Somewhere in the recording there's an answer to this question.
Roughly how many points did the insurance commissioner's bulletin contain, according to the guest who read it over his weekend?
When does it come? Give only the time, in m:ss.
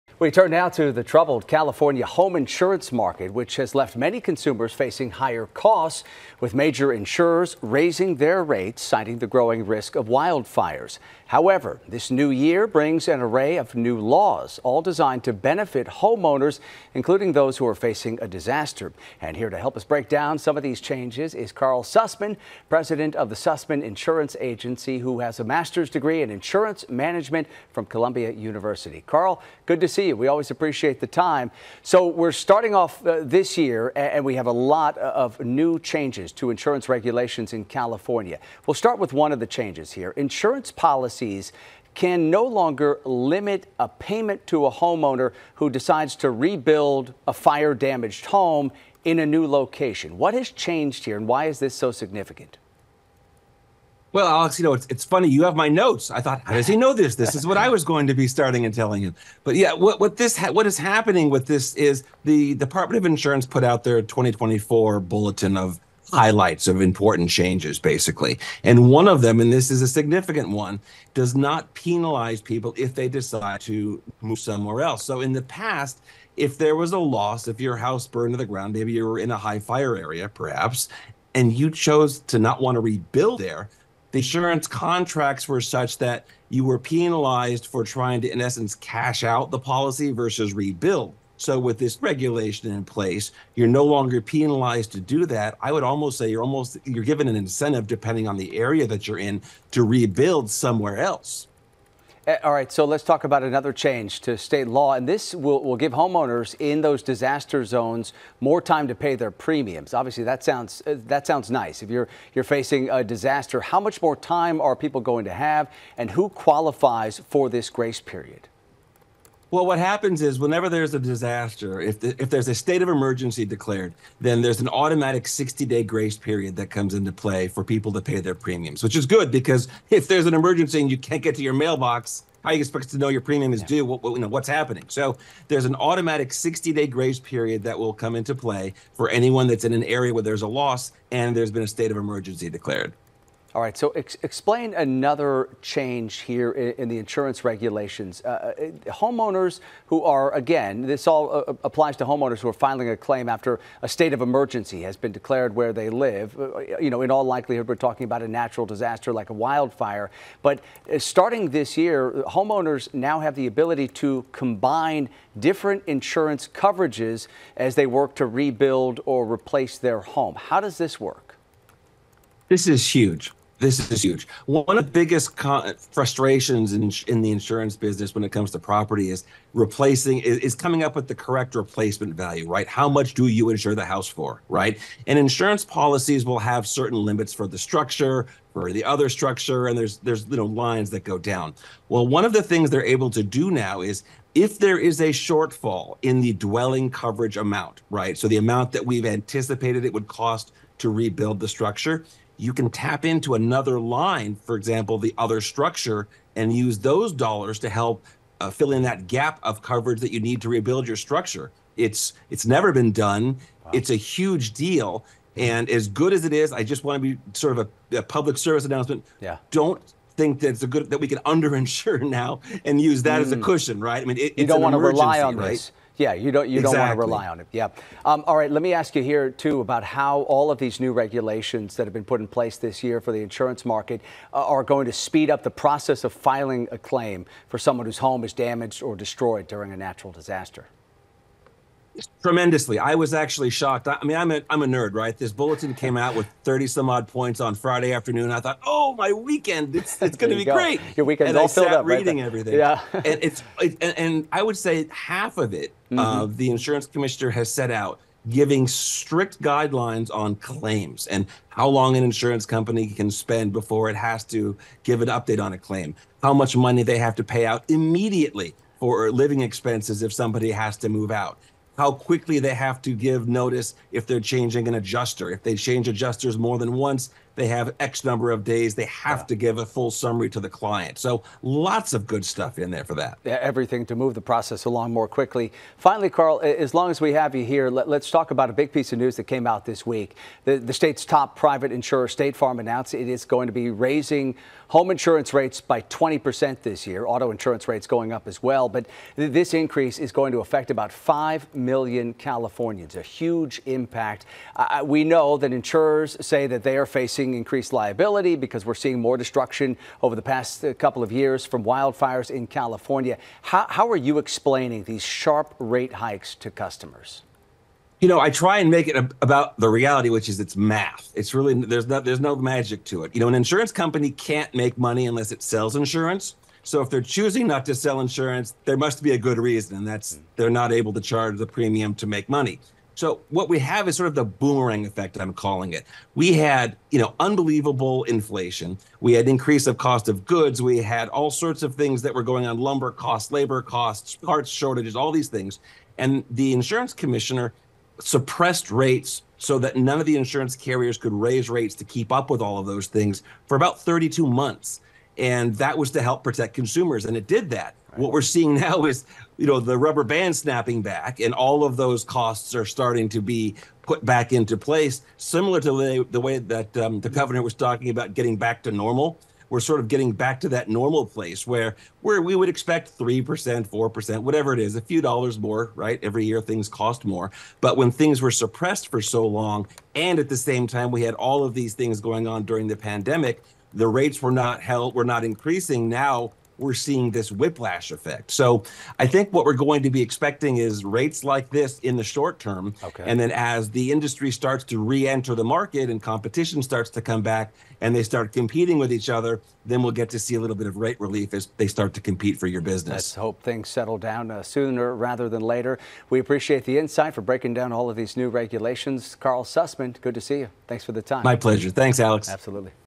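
4:06.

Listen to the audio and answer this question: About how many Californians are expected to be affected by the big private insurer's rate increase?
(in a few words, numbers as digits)
5 million.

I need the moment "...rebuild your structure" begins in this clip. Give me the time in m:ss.
3:30.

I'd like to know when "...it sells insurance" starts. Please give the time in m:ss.
5:25.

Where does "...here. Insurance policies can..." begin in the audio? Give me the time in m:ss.
0:39.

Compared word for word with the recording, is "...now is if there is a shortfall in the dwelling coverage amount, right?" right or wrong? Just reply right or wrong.
right.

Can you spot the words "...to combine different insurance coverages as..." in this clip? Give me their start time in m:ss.
2:43.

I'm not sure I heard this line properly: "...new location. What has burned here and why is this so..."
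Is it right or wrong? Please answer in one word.
wrong.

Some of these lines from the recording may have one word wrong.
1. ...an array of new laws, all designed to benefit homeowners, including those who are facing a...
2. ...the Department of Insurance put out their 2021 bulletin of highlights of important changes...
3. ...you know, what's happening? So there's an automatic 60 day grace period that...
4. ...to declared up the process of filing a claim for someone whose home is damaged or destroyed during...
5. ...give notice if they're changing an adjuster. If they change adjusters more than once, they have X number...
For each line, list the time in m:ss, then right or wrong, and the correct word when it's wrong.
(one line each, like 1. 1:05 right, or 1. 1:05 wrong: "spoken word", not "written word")
1. 0:13 right
2. 1:02 wrong: "2024", not "2021"
3. 2:14 right
4. 3:54 wrong: "speed", not "declared"
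5. 4:32 right.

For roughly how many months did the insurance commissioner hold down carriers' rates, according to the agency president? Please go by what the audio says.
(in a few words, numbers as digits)
32.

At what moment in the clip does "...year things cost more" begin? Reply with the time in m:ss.
6:16.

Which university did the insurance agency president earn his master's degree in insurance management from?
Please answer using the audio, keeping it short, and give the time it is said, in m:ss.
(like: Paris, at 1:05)
Columbia University, at 0:27.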